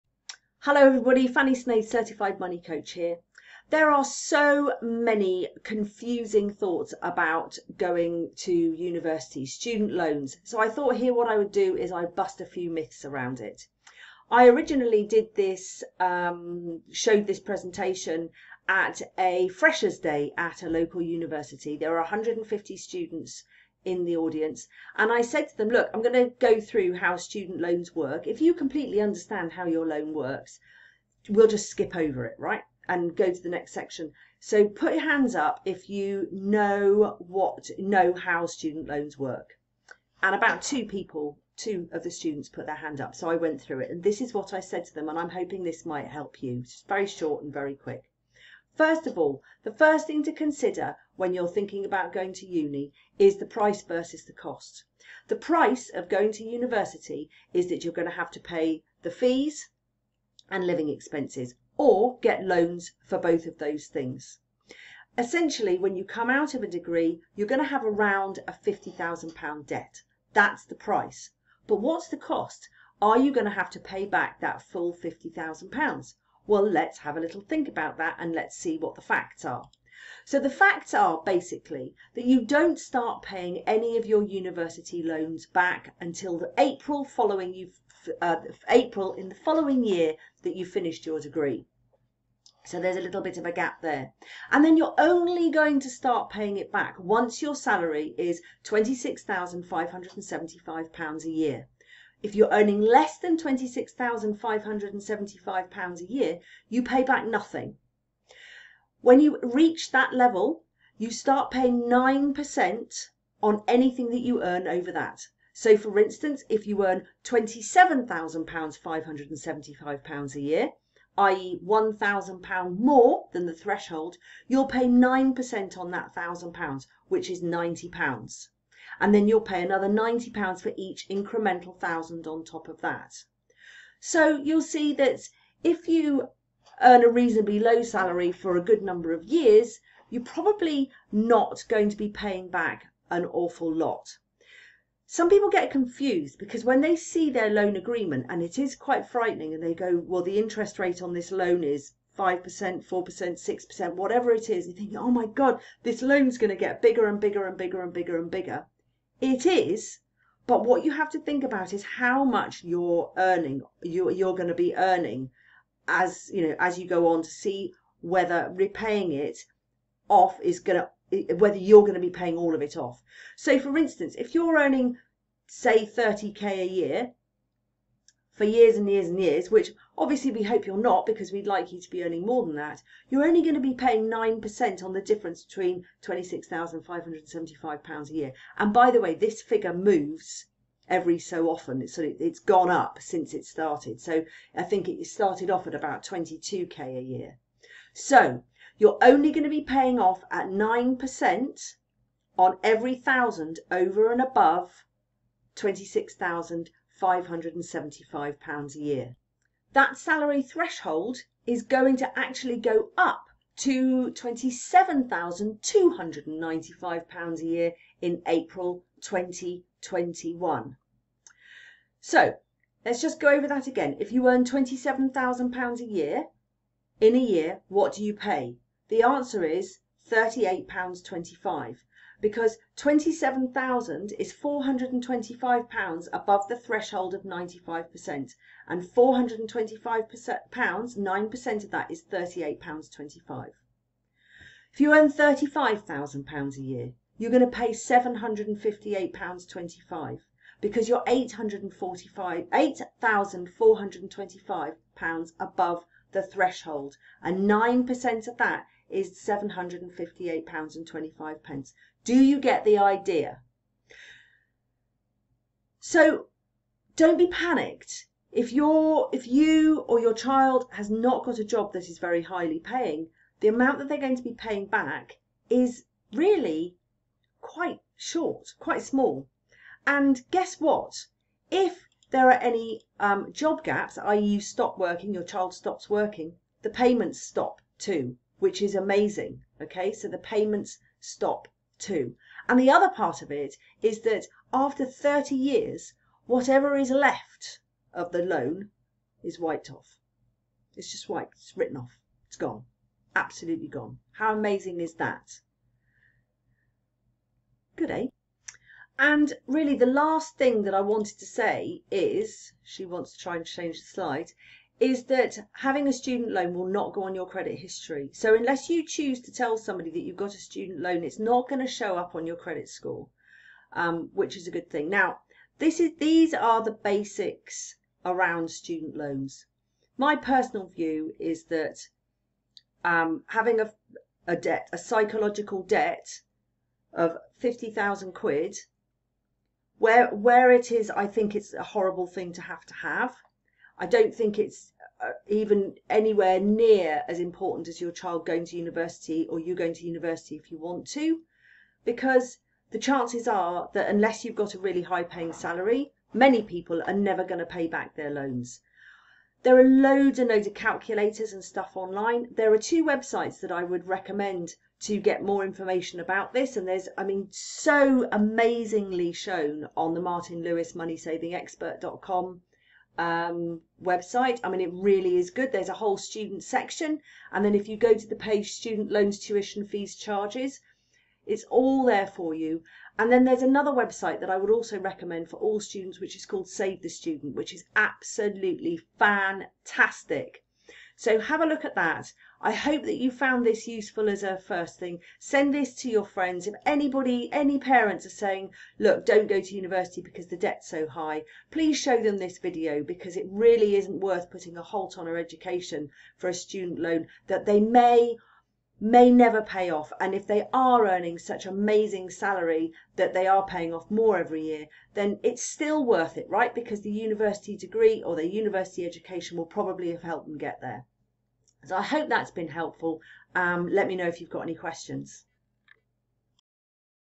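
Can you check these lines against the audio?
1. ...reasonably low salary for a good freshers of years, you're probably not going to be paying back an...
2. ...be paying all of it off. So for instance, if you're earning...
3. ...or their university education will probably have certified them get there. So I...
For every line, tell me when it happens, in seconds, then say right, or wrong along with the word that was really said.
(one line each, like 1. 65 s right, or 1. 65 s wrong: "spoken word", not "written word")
1. 137 s wrong: "number", not "freshers"
2. 172 s right
3. 418 s wrong: "helped", not "certified".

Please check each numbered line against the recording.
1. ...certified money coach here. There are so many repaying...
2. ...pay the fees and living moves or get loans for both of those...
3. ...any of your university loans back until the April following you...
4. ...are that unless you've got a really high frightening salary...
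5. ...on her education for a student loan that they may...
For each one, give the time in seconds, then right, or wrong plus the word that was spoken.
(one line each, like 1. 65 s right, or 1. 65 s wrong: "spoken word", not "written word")
1. 1 s wrong: "confusing", not "repaying"
2. 58 s wrong: "expenses", not "moves"
3. 83 s right
4. 353 s wrong: "paying", not "frightening"
5. 404 s right.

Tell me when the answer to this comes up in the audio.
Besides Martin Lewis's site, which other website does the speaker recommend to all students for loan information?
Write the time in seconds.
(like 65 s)
386 s.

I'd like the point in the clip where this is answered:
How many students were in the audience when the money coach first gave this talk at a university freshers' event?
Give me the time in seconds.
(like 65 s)
22 s.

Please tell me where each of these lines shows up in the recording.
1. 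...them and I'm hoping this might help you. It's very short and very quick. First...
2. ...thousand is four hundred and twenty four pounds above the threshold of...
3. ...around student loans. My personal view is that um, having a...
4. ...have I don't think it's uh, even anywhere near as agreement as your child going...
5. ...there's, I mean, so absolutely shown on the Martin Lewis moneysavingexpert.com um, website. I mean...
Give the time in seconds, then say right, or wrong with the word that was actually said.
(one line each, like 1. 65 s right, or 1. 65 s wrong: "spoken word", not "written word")
1. 44 s right
2. 233 s wrong: "five", not "four"
3. 328 s right
4. 342 s wrong: "important", not "agreement"
5. 366 s wrong: "amazingly", not "absolutely".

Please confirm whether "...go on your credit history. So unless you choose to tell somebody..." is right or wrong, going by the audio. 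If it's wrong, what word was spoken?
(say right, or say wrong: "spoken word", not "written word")
right.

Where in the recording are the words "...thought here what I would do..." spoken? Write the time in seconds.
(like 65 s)
10 s.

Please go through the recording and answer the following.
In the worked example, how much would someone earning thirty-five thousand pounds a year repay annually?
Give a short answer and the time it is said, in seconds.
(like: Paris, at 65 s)
£758.25, at 259 s.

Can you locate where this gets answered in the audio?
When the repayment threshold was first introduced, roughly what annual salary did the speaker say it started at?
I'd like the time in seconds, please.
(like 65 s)
196 s.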